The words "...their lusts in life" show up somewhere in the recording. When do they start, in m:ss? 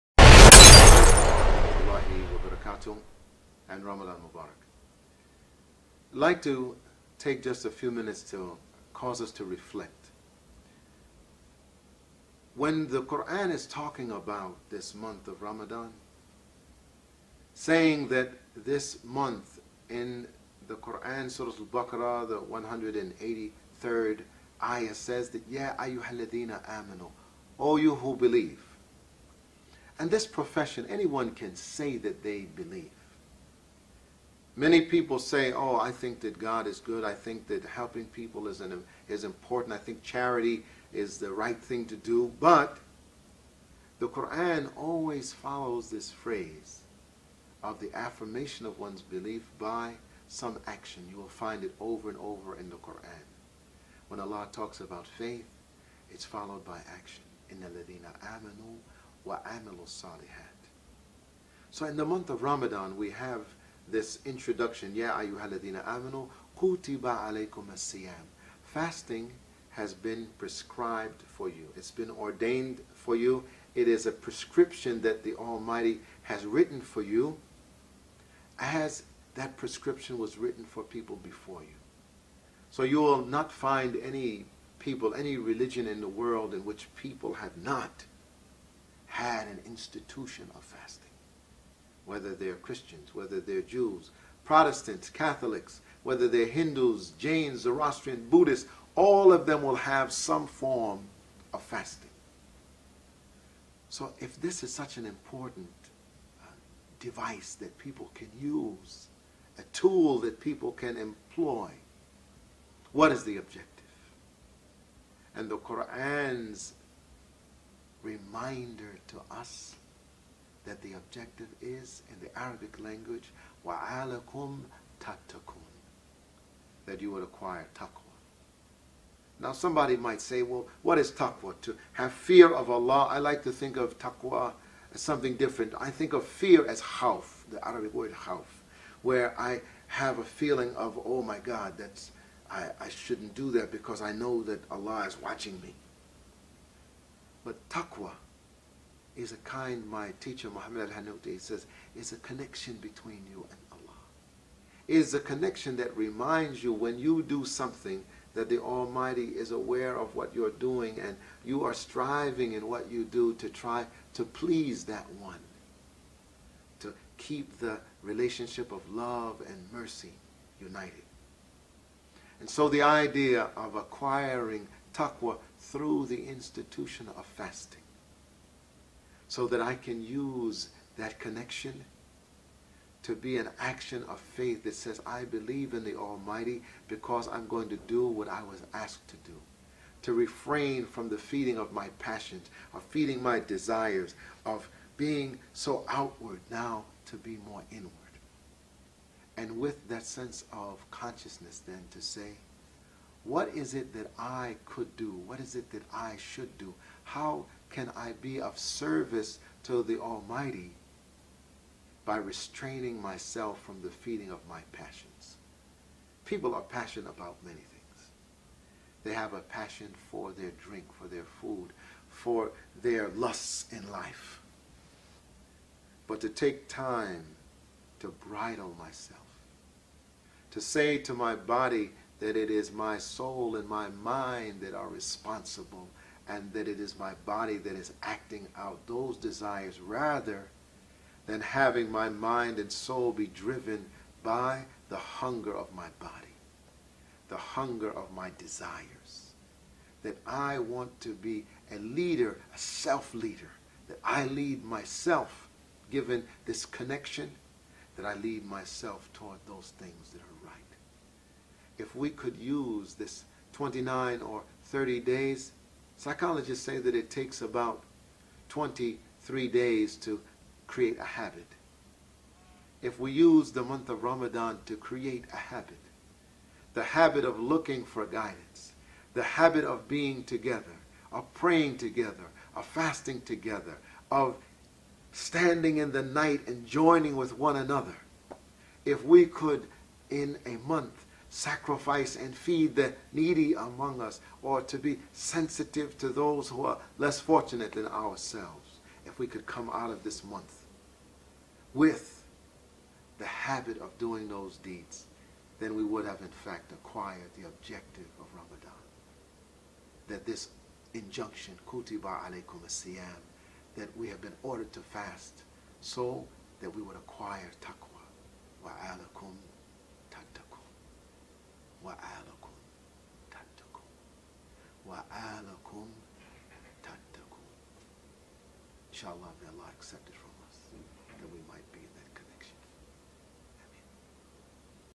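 3:42.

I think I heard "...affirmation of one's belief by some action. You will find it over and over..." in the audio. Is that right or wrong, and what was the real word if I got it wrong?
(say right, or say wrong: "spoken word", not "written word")
right.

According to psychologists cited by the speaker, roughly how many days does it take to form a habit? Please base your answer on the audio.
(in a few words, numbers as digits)
23.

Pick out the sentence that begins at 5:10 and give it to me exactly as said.
That this injunction, kutiba alaykum siyam, that we have been ordered to fast so that we would acquire taqwa.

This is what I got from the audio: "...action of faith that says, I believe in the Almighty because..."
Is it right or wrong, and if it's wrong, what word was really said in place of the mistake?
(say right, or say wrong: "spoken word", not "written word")
right.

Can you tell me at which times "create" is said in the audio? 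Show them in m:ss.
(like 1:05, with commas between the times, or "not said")
4:30, 4:34.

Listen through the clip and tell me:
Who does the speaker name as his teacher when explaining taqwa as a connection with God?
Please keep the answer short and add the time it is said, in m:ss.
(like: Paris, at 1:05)
Muhammad al-Hanouti, at 2:30.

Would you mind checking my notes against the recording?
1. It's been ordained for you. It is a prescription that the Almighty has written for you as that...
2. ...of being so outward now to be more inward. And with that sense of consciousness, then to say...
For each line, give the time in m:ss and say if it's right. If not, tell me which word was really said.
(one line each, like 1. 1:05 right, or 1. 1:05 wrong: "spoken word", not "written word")
1. 1:11 right
2. 3:14 right.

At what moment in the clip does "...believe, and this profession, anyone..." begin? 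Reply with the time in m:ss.
0:28.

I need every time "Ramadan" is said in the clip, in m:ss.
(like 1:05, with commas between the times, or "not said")
0:03, 0:15, 1:02, 4:34, 5:08.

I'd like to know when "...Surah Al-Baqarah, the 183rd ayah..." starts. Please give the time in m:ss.
0:21.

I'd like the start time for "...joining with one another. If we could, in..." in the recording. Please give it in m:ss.
4:46.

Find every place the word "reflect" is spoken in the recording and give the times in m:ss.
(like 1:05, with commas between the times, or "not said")
0:09.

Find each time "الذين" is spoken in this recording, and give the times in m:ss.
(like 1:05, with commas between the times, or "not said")
0:57, 1:05.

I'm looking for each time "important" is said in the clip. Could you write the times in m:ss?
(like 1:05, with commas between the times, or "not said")
0:39, 1:45.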